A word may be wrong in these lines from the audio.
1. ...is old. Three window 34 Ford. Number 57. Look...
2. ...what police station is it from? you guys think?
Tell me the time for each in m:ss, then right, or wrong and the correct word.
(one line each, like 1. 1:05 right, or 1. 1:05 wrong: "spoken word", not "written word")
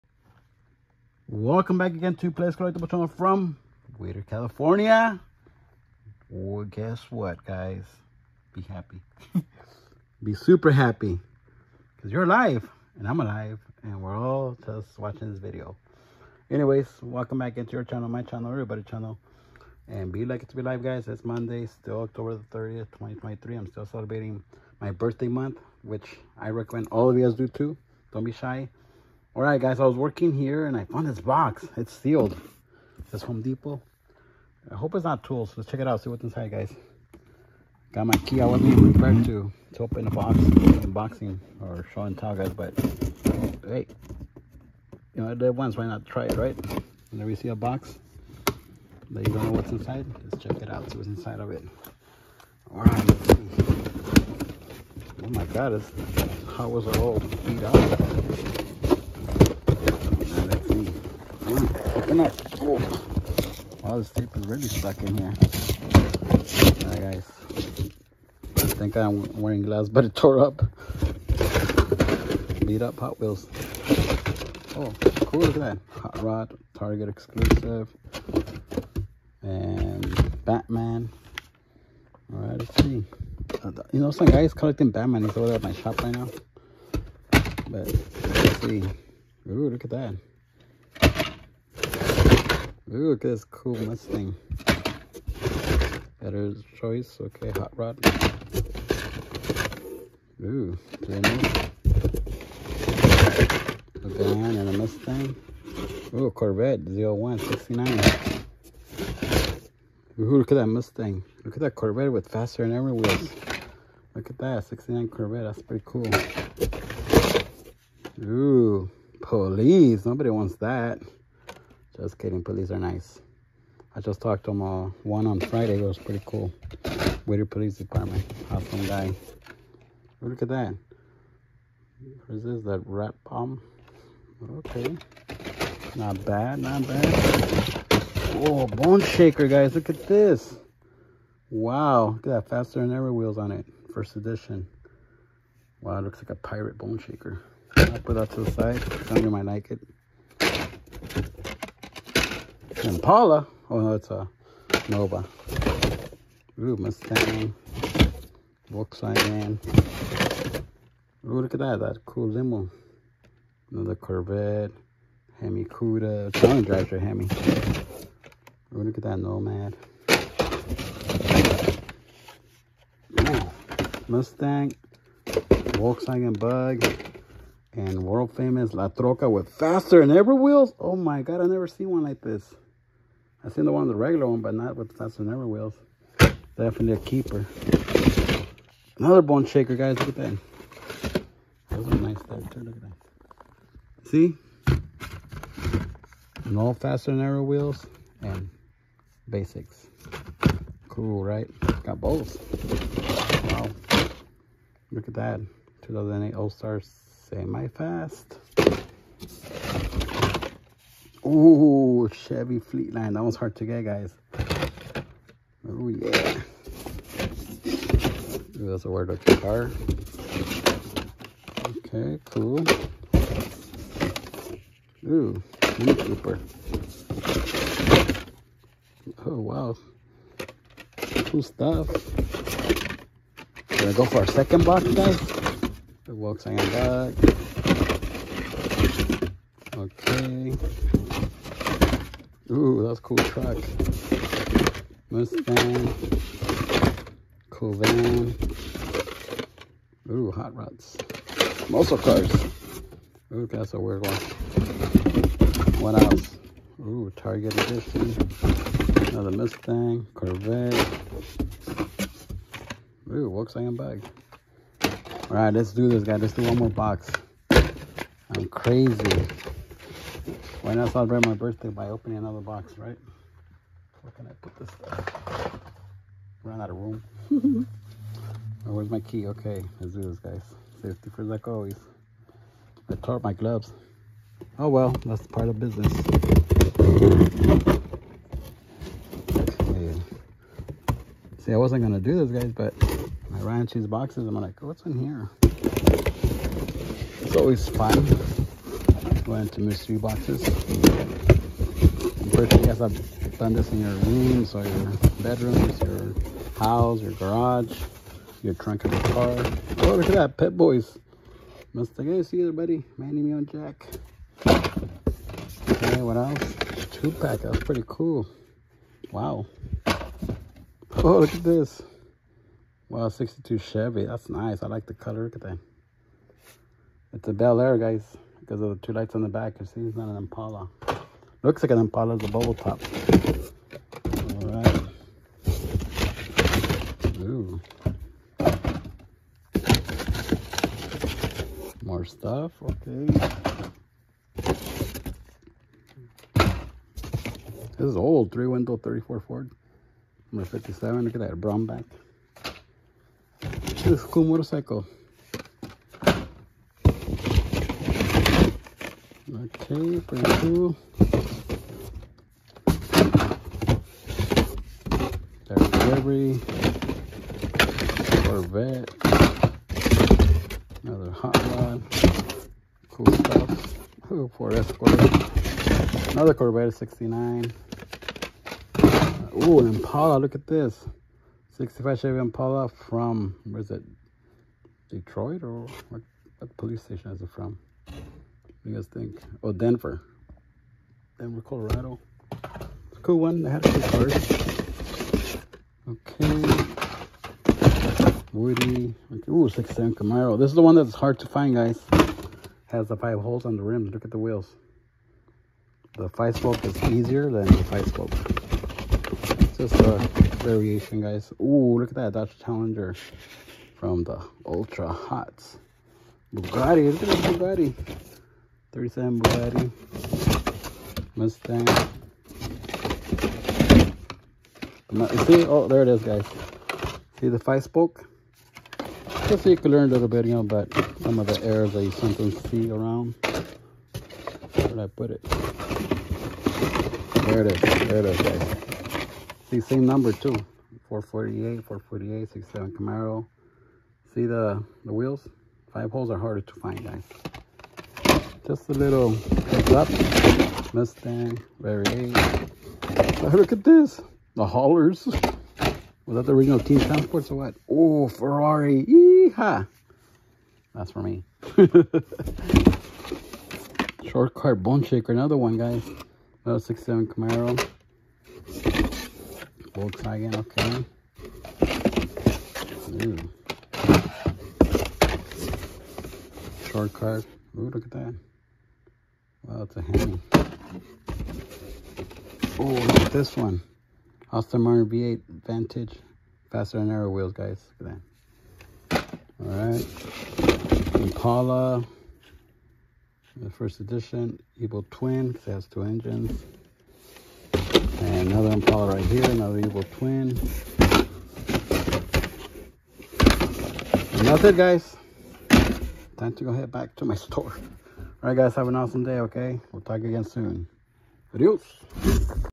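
1. 5:47 right
2. 6:26 right.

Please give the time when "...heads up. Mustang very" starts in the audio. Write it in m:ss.
7:29.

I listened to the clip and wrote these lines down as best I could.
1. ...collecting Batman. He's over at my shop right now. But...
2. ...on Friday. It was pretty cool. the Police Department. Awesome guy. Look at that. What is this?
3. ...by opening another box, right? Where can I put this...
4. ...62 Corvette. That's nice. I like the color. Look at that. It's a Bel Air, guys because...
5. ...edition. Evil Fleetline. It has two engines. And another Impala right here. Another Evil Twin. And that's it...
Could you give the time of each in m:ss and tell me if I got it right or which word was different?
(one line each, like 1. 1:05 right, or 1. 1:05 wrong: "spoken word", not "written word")
1. 1:24 right
2. 2:05 right
3. 4:31 right
4. 5:23 wrong: "Chevy", not "Corvette"
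5. 8:13 wrong: "Twin", not "Fleetline".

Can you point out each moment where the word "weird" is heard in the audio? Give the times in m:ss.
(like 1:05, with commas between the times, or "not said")
3:38, 4:13.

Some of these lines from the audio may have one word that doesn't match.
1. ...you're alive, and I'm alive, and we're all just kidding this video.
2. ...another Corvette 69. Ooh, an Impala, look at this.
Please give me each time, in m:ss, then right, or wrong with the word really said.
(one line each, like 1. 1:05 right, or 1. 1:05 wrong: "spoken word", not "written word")
1. 0:12 wrong: "watching", not "kidding"
2. 6:16 right.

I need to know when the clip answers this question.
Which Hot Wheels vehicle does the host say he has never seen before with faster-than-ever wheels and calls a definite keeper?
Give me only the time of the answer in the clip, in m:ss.
2:58.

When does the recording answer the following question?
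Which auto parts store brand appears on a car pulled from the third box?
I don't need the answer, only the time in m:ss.
5:10.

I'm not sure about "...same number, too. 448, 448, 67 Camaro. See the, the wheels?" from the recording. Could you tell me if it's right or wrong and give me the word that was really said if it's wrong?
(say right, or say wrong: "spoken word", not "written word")
right.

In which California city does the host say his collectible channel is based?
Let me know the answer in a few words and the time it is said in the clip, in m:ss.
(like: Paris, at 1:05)
Whittier, at 0:03.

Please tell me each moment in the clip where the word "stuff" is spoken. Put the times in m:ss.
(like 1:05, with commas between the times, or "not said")
3:51, 4:34, 5:42, 6:13.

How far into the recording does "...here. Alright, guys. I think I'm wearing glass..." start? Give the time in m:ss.
1:05.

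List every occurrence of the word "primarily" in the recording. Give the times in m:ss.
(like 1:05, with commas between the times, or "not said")
not said.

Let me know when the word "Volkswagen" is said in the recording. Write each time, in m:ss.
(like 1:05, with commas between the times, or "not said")
2:38, 2:55, 3:56, 4:23, 7:49.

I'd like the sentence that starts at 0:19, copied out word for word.
And be lucky to be live, guys.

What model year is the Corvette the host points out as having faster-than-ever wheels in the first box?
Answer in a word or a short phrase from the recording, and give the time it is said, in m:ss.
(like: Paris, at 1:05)
69, at 1:54.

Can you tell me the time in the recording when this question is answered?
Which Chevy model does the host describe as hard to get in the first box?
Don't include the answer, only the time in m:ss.
3:32.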